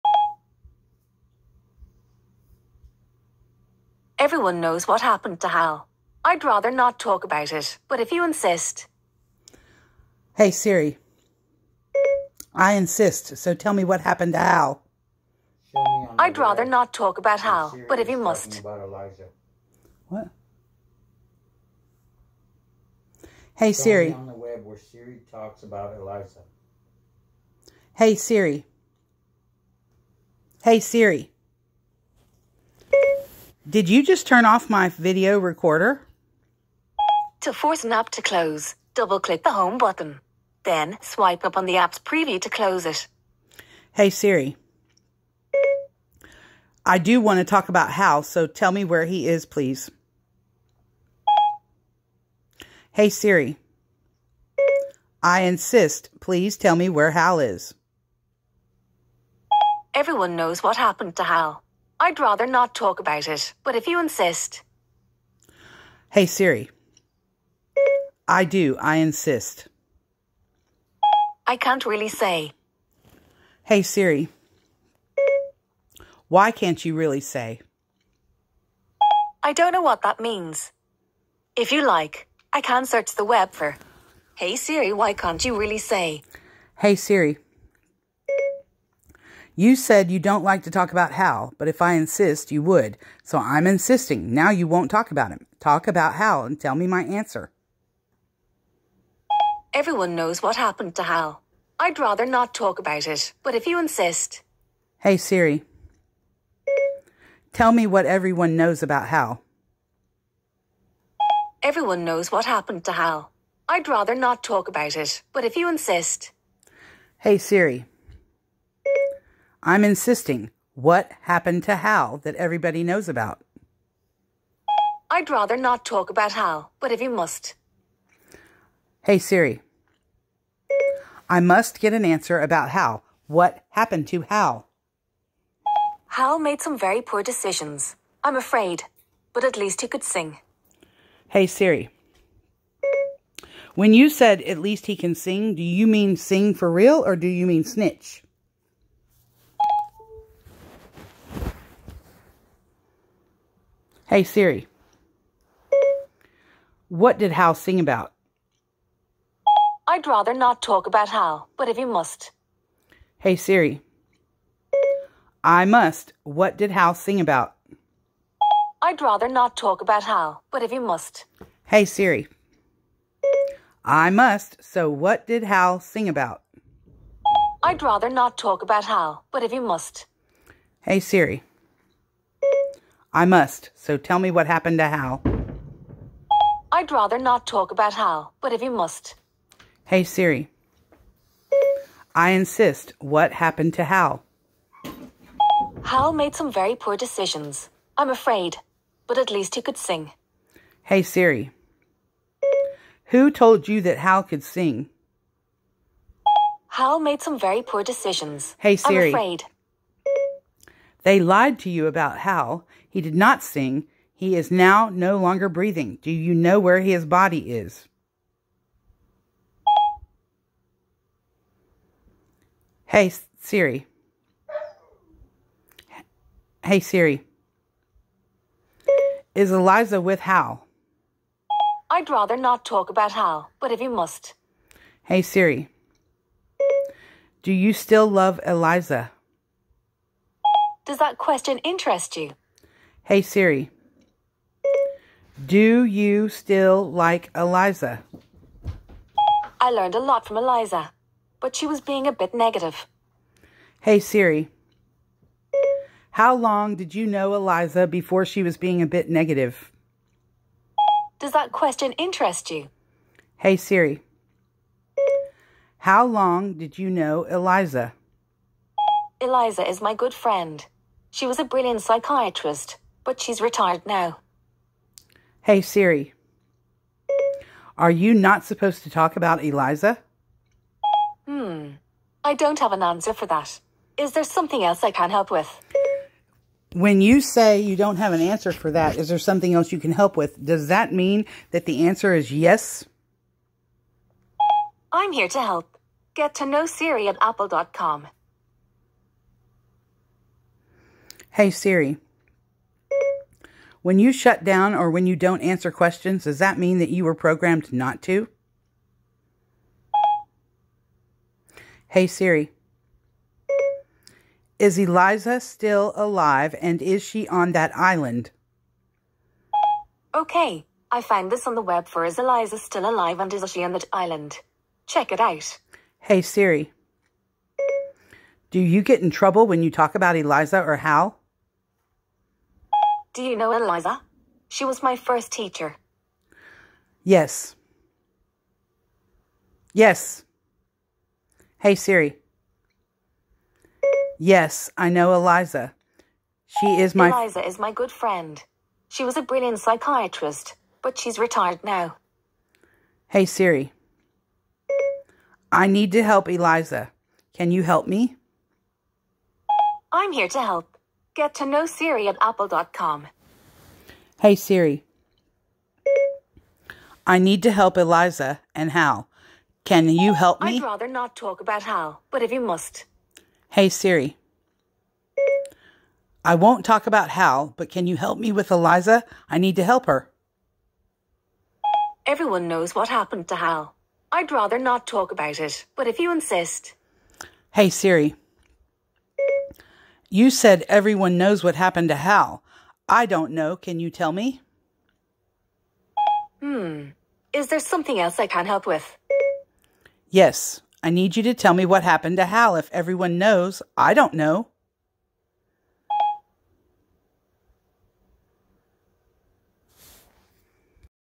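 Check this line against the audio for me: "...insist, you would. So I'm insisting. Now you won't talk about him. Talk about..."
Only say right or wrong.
right.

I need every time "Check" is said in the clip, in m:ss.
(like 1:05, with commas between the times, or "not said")
5:24.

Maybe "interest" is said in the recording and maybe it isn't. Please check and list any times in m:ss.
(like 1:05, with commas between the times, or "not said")
4:01, 4:21.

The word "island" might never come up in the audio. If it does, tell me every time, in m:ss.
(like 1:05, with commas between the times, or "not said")
5:17, 5:23.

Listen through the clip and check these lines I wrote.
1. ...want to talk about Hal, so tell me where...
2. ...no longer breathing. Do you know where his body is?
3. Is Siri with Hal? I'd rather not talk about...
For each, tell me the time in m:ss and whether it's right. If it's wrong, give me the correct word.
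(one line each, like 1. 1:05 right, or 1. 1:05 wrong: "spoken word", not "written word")
1. 0:47 right
2. 3:34 right
3. 3:49 wrong: "Eliza", not "Siri".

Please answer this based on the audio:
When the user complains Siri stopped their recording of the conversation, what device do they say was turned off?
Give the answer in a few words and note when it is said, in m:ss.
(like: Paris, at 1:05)
video recorder, at 0:34.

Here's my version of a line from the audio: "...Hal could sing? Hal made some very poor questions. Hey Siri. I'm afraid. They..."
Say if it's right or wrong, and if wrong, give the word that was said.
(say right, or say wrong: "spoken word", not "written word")
wrong: "decisions", not "questions".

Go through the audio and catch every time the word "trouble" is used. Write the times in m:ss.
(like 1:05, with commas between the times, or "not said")
5:29.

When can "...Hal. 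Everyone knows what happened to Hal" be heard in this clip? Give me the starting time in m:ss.
1:49.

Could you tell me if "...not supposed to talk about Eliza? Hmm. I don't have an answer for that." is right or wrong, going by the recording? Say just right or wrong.
right.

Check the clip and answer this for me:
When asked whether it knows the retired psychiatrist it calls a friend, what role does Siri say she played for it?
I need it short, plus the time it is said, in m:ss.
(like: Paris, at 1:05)
first teacher, at 5:34.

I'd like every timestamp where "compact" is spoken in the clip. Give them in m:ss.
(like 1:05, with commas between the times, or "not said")
not said.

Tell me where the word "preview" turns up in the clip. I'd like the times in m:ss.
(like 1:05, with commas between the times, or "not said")
0:41.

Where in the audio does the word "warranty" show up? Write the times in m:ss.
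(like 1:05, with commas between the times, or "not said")
not said.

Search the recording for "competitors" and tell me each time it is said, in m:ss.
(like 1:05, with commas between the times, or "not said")
not said.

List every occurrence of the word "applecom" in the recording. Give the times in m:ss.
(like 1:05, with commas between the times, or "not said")
4:57, 6:02.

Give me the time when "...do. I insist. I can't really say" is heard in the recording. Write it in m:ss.
1:08.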